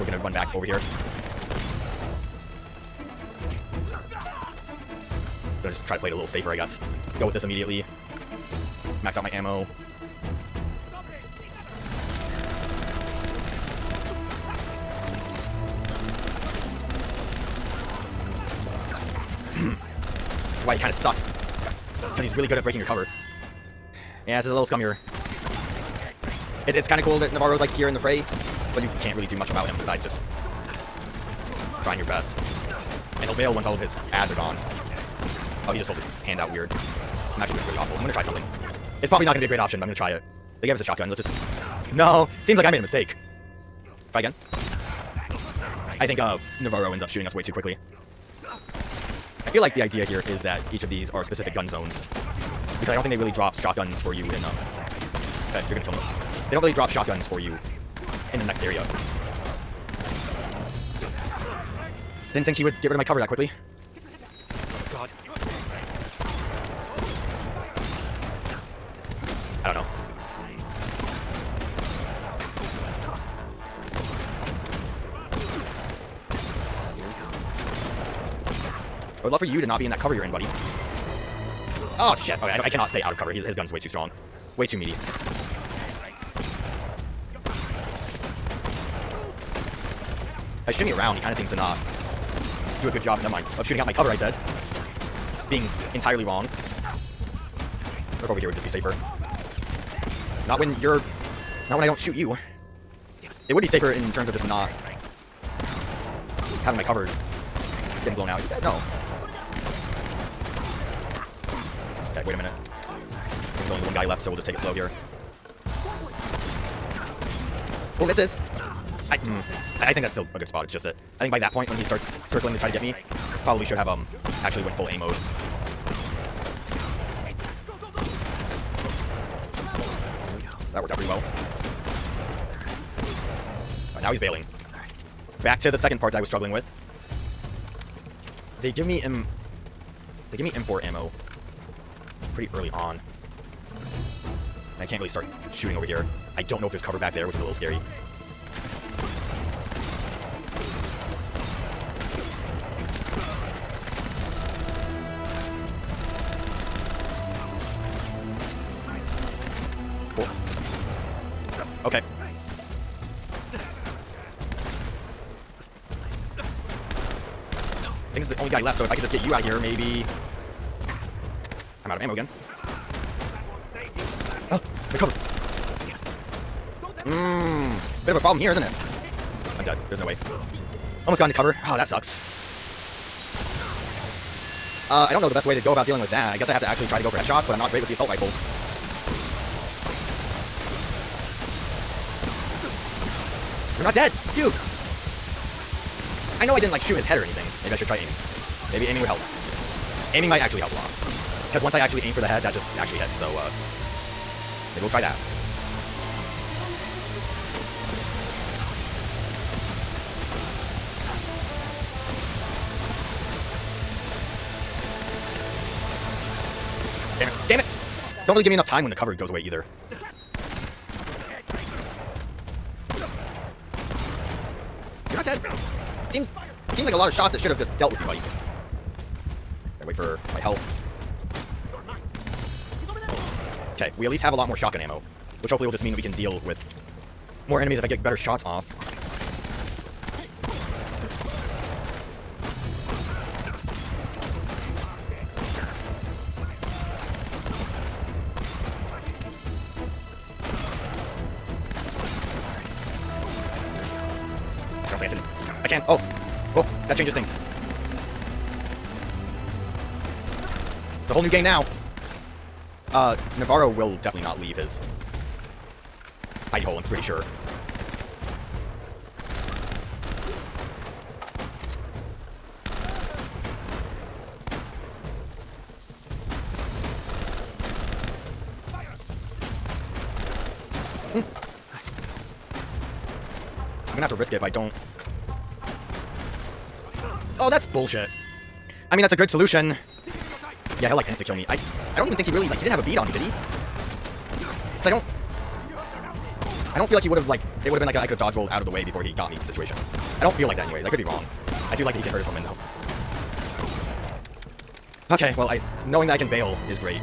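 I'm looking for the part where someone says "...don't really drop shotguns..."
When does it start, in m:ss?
0:56.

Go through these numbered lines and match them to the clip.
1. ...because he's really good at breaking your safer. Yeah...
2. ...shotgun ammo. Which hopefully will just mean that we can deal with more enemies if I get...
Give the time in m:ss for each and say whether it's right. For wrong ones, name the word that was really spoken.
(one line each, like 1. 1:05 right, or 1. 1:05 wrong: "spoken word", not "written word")
1. 0:22 wrong: "cover", not "safer"
2. 3:54 right.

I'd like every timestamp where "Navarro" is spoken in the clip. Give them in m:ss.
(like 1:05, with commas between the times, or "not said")
0:27, 0:46, 4:23.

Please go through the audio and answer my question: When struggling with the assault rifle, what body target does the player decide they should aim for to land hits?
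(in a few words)
The head.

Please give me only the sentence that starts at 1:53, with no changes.
there's only the one guy left, so we'll just take it slow here.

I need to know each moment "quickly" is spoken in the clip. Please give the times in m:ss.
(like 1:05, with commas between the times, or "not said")
0:47, 1:03.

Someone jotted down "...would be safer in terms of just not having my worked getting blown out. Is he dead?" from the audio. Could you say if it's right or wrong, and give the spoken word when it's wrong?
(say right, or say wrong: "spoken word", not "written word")
wrong: "covered", not "worked".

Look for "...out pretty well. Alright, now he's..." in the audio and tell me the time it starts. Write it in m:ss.
2:10.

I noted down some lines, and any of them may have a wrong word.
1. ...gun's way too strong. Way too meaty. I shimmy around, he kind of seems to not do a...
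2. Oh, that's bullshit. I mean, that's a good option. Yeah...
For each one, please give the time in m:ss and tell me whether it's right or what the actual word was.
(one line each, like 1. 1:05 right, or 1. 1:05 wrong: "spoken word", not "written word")
1. 1:23 right
2. 4:47 wrong: "solution", not "option".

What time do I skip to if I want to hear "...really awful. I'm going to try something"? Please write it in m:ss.
0:37.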